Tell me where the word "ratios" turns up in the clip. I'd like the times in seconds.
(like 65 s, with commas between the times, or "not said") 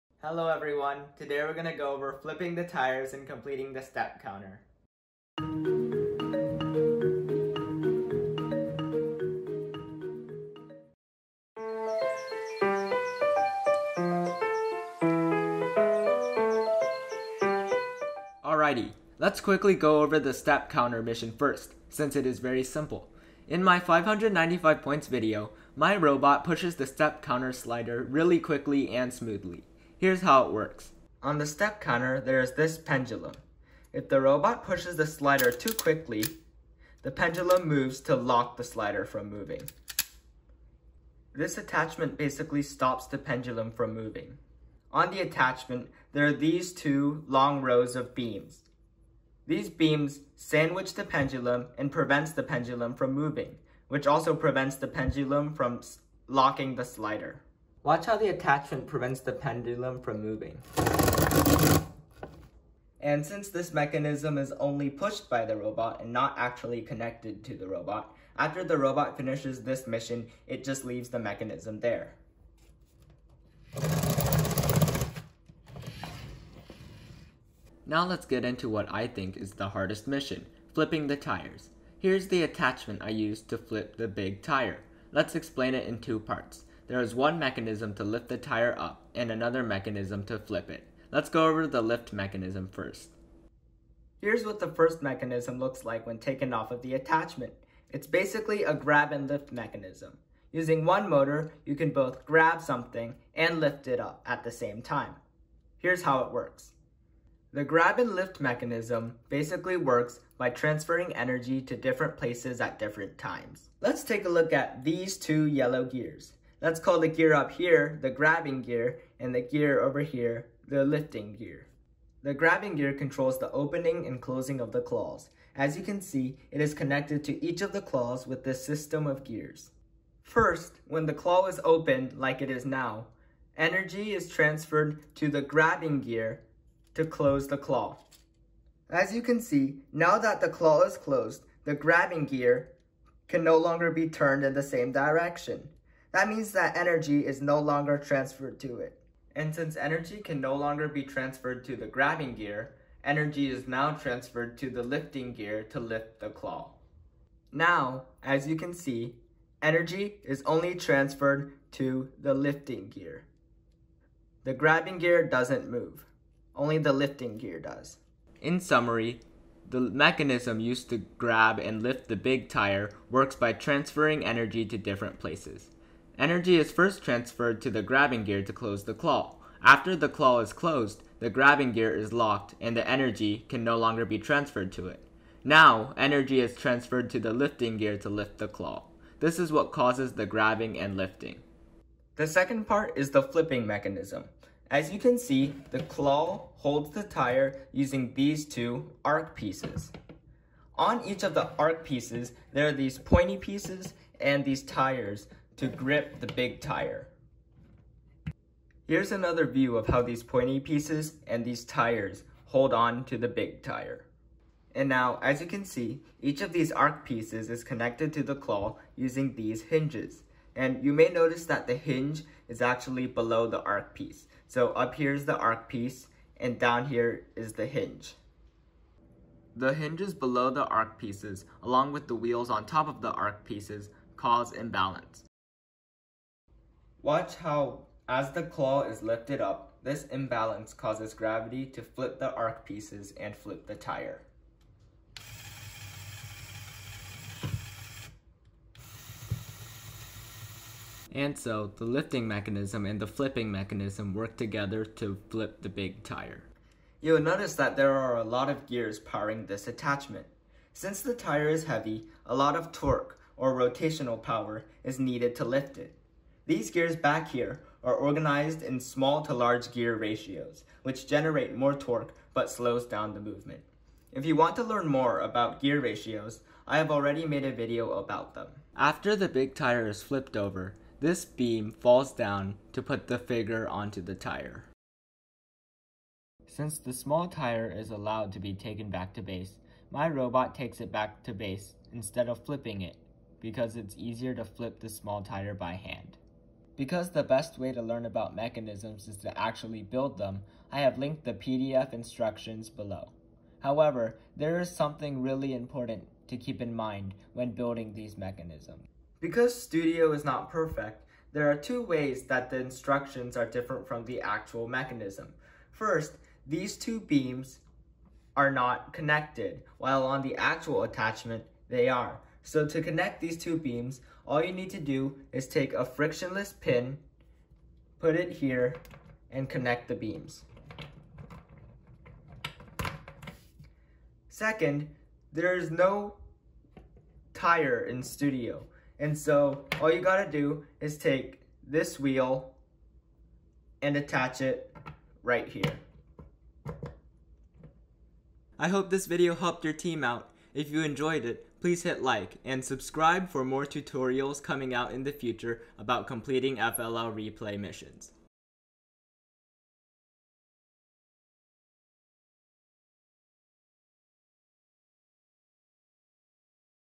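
269 s, 275 s.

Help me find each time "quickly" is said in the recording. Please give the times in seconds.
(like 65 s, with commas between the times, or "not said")
19 s, 28 s, 35 s.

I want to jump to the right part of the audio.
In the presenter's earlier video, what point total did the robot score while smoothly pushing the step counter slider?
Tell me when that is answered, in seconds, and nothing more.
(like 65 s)
23 s.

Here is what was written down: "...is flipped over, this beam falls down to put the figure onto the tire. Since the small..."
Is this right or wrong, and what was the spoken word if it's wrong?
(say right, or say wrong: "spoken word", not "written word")
right.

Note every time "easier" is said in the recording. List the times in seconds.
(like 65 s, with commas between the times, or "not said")
293 s.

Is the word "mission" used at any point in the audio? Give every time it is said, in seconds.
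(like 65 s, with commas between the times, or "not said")
21 s, 69 s, 80 s, 357 s.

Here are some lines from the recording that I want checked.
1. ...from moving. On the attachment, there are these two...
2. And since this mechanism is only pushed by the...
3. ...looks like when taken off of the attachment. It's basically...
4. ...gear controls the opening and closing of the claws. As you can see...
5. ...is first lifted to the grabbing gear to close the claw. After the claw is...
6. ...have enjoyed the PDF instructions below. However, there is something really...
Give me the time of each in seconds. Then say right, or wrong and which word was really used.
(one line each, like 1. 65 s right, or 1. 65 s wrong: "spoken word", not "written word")
1. 43 s right
2. 62 s right
3. 95 s right
4. 122 s right
5. 176 s wrong: "transferred", not "lifted"
6. 300 s wrong: "linked", not "enjoyed".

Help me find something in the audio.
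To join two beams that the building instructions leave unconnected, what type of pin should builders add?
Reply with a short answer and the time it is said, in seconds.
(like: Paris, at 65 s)
frictionless pin, at 325 s.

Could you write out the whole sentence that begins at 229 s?
The hinges below the arc pieces, along with the wheels on top of the arc pieces, cause imbalance.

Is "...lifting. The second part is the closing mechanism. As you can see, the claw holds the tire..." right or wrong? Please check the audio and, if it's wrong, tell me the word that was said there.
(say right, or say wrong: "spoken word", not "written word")
wrong: "flipping", not "closing".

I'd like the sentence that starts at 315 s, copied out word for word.
First, these two beams are not connected, while on the actual attachment, they are.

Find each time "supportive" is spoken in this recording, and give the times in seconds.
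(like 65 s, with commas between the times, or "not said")
not said.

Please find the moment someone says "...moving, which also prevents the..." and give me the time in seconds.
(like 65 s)
53 s.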